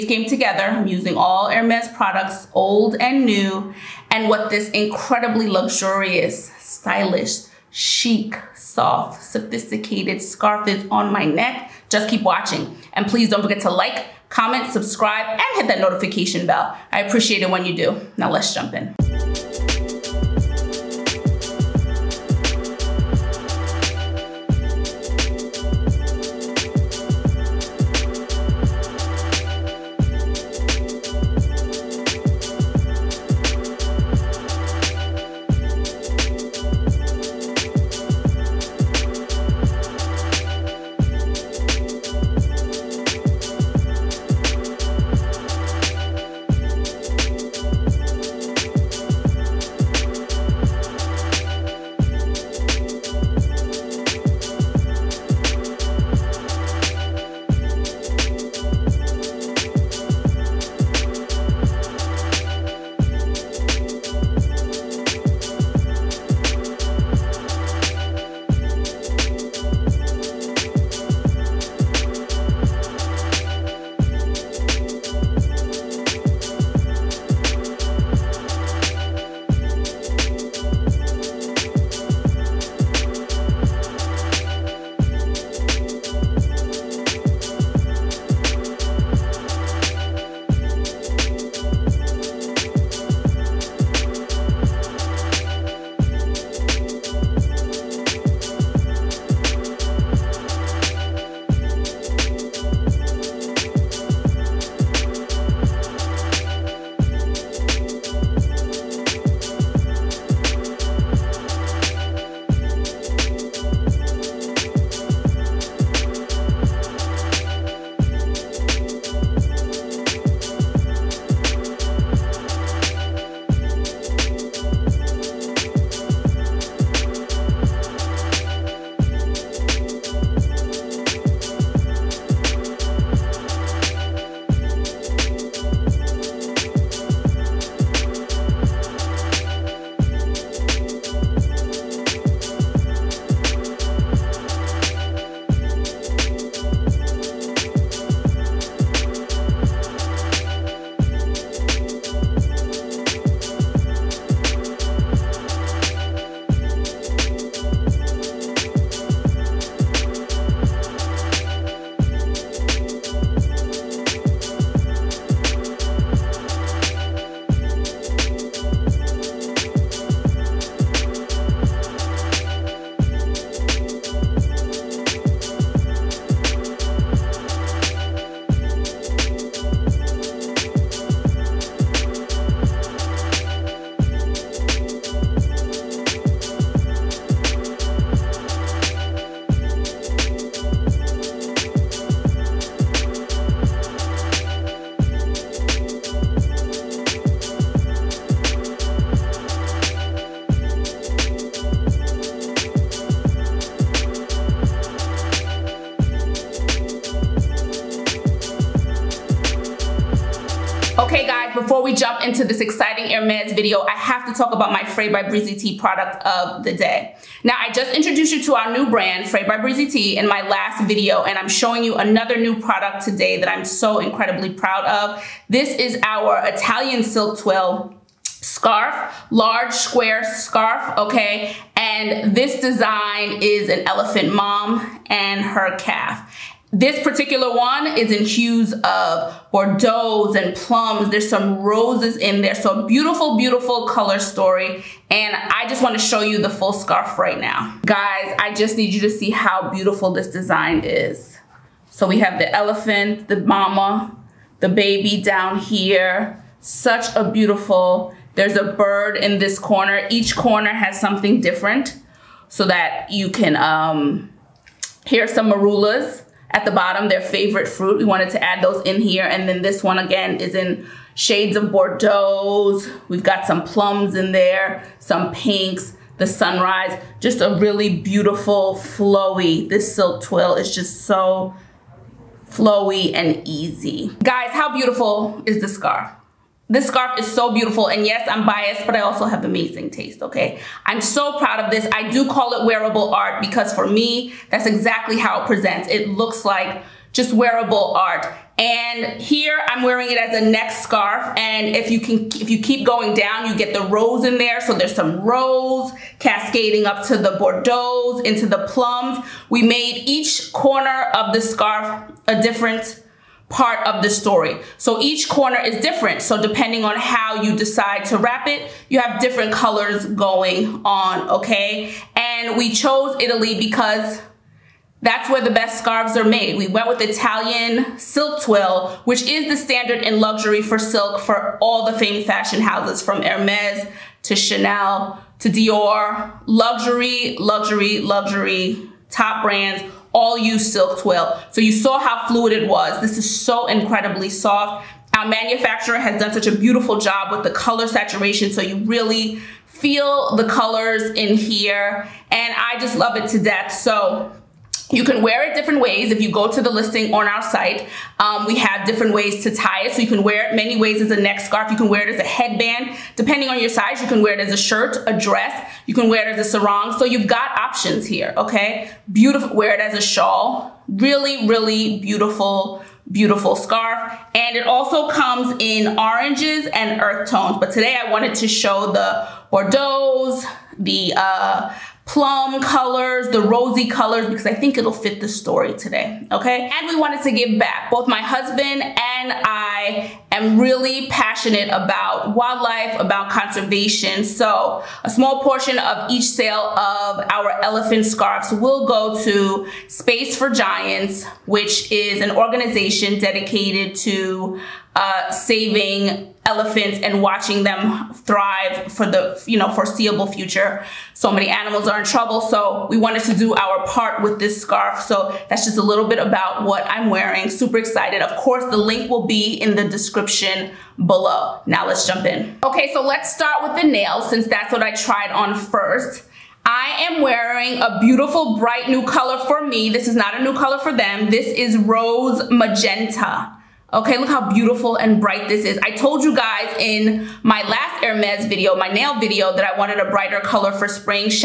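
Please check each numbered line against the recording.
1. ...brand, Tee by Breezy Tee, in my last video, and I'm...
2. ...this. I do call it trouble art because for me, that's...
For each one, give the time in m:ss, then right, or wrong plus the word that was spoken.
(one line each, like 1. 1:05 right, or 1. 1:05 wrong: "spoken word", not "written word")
1. 3:38 wrong: "Frais", not "Tee"
2. 4:51 wrong: "wearable", not "trouble".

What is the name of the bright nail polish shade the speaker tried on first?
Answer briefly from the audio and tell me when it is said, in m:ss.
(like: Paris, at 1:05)
Rose Magenta, at 7:11.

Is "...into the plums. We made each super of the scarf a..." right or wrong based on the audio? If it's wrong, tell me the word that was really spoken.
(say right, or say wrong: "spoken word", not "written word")
wrong: "corner", not "super".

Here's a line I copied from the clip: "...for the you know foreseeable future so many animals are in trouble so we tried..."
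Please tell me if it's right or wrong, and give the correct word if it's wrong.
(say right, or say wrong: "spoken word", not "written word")
wrong: "wanted", not "tried".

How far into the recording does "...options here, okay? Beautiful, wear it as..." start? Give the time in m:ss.
6:07.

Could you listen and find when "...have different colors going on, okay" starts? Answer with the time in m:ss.
5:18.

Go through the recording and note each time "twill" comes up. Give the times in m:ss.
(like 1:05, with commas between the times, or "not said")
3:47, 4:40, 5:28, 5:40.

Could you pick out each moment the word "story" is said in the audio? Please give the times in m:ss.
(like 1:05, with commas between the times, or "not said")
4:04, 5:14, 6:25.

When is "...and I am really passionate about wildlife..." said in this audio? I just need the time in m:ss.
6:28.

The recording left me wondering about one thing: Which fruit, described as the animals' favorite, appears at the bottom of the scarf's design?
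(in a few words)
Marulas.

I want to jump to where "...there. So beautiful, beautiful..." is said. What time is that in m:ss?
4:02.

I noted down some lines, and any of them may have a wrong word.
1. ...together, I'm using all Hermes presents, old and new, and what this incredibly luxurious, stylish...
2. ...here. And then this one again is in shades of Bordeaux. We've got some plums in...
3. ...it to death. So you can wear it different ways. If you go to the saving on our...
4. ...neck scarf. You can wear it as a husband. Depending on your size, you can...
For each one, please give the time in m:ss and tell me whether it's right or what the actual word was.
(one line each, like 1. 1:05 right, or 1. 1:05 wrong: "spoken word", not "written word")
1. 0:00 wrong: "products", not "presents"
2. 4:29 right
3. 5:53 wrong: "listing", not "saving"
4. 6:01 wrong: "headband", not "husband".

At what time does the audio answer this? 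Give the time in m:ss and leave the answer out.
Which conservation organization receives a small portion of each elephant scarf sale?
6:39.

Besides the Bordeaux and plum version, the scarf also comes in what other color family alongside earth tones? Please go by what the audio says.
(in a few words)
Oranges.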